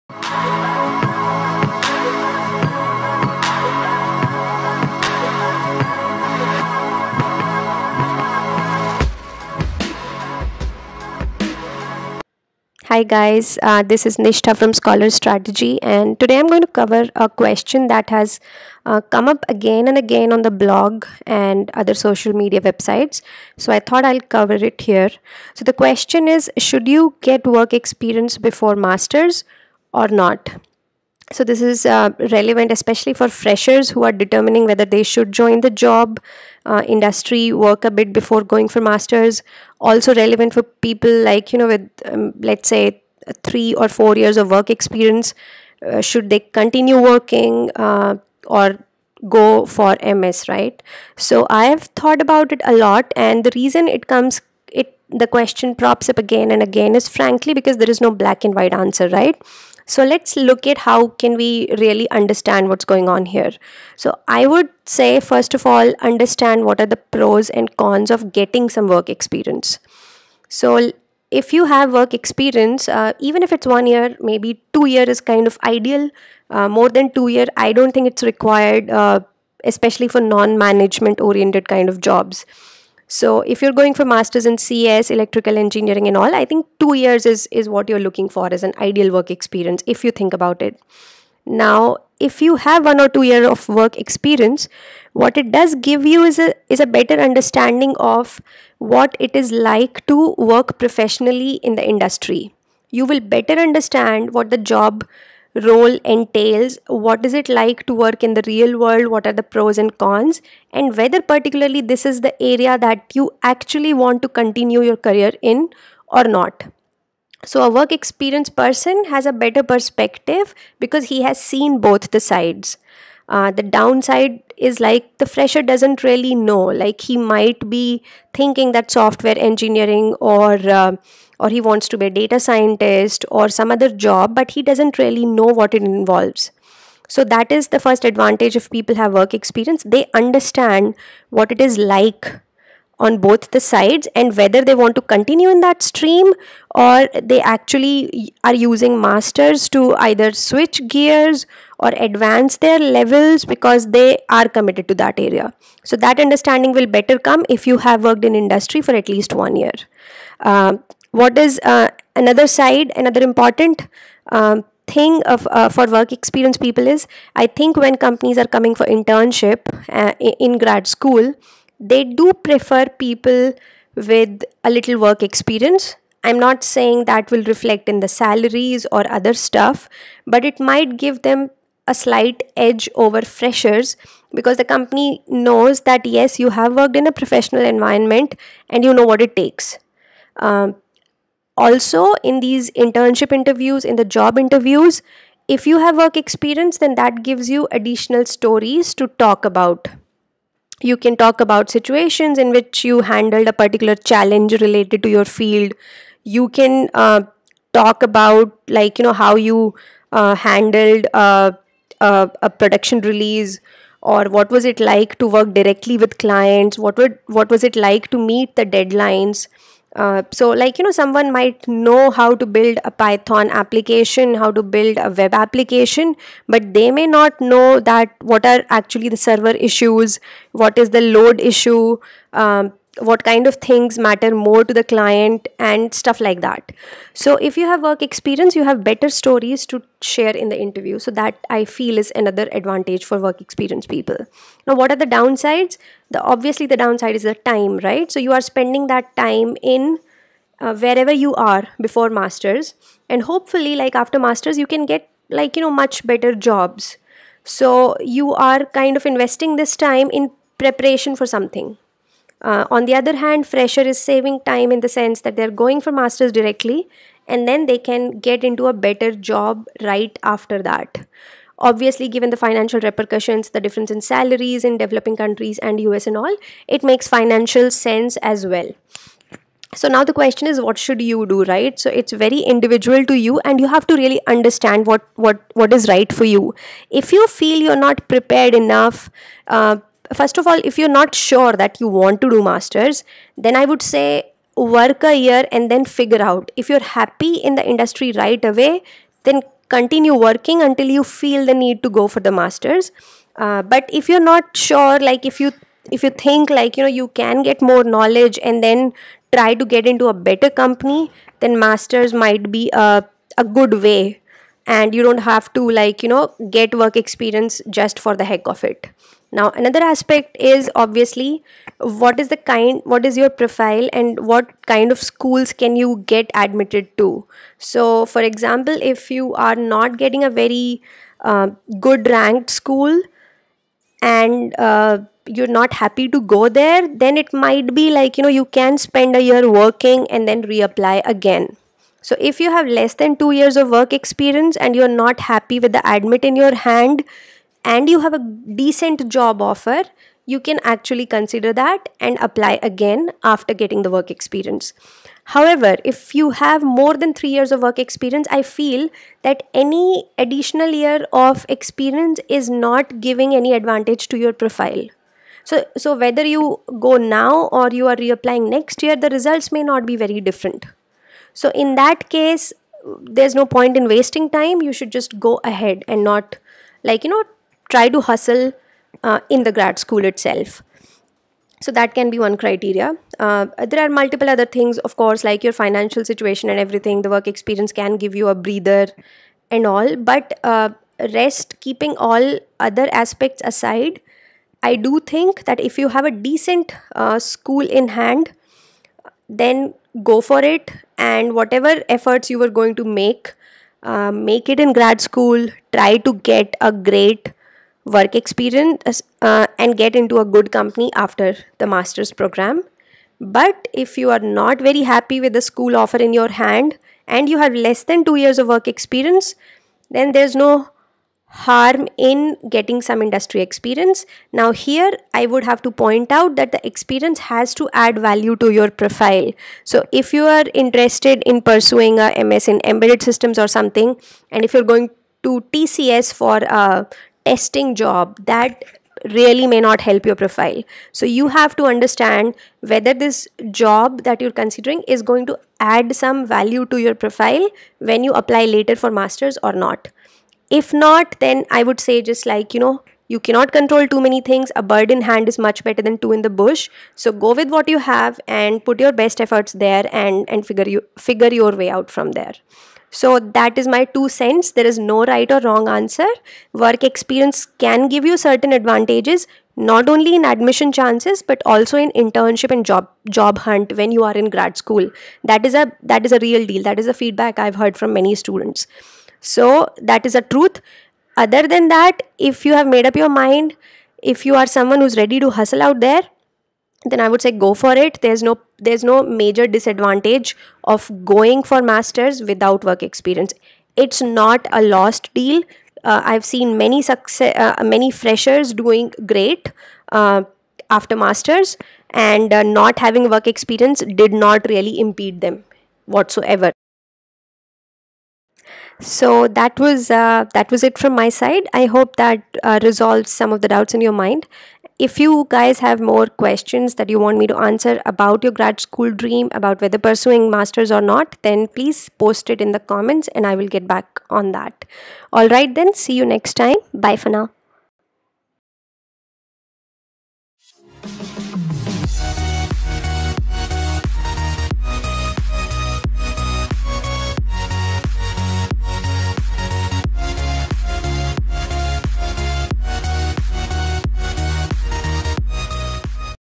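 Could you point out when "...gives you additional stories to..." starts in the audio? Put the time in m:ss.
3:17.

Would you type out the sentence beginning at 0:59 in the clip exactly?
Right so let's look at how can we really understand what's going on here.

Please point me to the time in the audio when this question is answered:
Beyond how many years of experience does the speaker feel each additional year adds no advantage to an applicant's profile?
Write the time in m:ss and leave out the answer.
5:57.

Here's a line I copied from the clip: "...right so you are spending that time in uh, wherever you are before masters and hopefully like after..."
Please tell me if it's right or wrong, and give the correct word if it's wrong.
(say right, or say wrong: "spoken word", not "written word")
right.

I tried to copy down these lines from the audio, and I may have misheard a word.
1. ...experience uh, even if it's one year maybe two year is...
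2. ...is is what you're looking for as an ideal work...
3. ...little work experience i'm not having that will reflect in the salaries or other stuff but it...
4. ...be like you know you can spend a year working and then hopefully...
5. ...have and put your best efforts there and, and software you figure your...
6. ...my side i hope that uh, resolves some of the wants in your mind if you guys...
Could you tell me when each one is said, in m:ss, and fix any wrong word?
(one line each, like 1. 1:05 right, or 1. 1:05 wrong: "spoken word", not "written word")
1. 1:12 right
2. 1:27 right
3. 2:54 wrong: "saying", not "having"
4. 5:37 wrong: "reapply", not "hopefully"
5. 7:37 wrong: "figure", not "software"
6. 8:30 wrong: "doubts", not "wants".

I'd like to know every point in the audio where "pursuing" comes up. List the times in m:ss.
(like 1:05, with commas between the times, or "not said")
7:11, 8:39.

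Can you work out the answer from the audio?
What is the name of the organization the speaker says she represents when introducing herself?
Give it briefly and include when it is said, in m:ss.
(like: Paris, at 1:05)
Scholar Strategy, at 0:14.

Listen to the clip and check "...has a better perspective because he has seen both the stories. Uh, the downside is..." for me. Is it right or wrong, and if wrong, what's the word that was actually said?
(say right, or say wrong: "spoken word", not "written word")
wrong: "sides", not "stories".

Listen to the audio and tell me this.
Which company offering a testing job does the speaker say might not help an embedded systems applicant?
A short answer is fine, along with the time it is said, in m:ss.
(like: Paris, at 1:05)
TCS, at 7:15.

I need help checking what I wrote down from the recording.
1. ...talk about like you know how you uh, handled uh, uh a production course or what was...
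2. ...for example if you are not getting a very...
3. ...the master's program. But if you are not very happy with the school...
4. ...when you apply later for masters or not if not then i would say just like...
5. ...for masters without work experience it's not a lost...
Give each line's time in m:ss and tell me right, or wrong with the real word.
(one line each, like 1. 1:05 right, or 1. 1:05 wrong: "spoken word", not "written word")
1. 3:27 wrong: "release", not "course"
2. 5:28 right
3. 6:51 right
4. 7:27 right
5. 8:11 right.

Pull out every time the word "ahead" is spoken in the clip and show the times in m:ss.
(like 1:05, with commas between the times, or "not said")
6:15.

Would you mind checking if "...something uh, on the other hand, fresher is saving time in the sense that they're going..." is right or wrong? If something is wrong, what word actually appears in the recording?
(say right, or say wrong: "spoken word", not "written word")
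right.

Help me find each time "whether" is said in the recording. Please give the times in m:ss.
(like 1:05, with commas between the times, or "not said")
0:34, 1:50, 2:24, 6:05, 7:22, 8:39.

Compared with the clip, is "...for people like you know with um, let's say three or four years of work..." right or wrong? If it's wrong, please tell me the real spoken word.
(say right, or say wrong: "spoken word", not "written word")
right.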